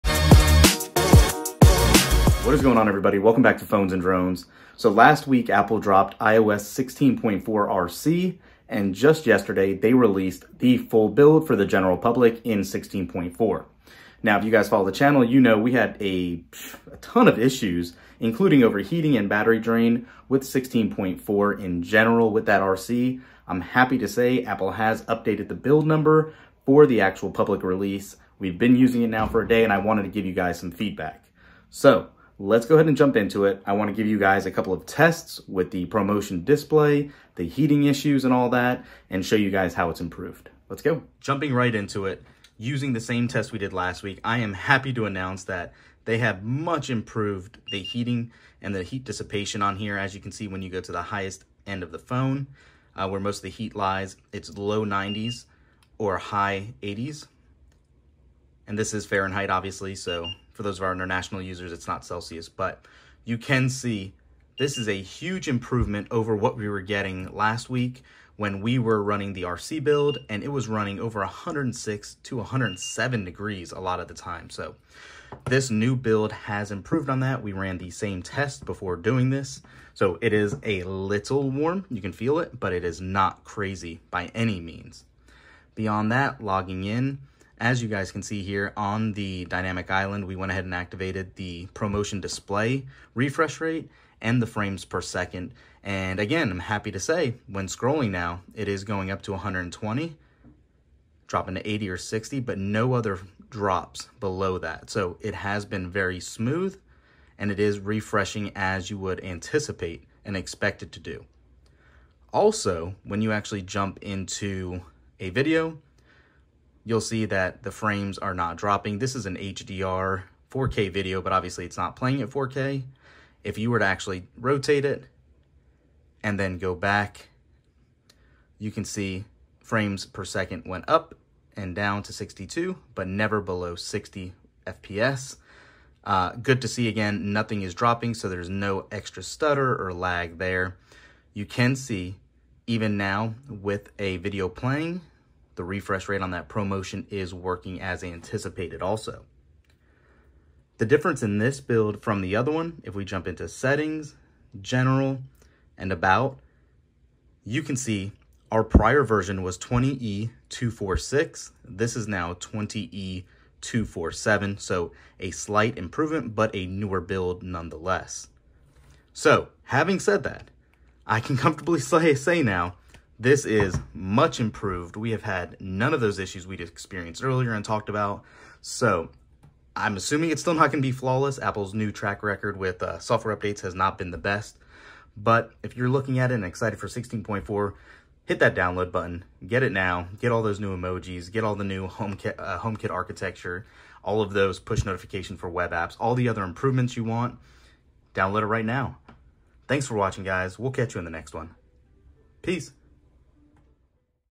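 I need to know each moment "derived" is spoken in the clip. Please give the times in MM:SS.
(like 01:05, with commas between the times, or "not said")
not said.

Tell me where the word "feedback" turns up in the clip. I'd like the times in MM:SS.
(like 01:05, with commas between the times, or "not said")
00:30.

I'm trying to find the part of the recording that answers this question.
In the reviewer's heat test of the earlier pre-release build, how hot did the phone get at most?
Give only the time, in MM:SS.
01:11.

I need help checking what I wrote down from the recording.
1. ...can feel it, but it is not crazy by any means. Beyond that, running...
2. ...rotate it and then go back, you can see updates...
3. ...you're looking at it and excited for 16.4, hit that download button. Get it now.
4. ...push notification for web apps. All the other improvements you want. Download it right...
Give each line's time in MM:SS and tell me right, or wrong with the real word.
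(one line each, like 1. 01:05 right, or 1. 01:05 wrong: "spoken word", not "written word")
1. 01:22 wrong: "logging", not "running"
2. 02:04 wrong: "frames", not "updates"
3. 03:05 right
4. 03:14 right.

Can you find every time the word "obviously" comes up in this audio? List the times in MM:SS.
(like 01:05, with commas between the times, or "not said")
00:59, 02:01.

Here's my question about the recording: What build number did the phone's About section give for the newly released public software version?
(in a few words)
20E247.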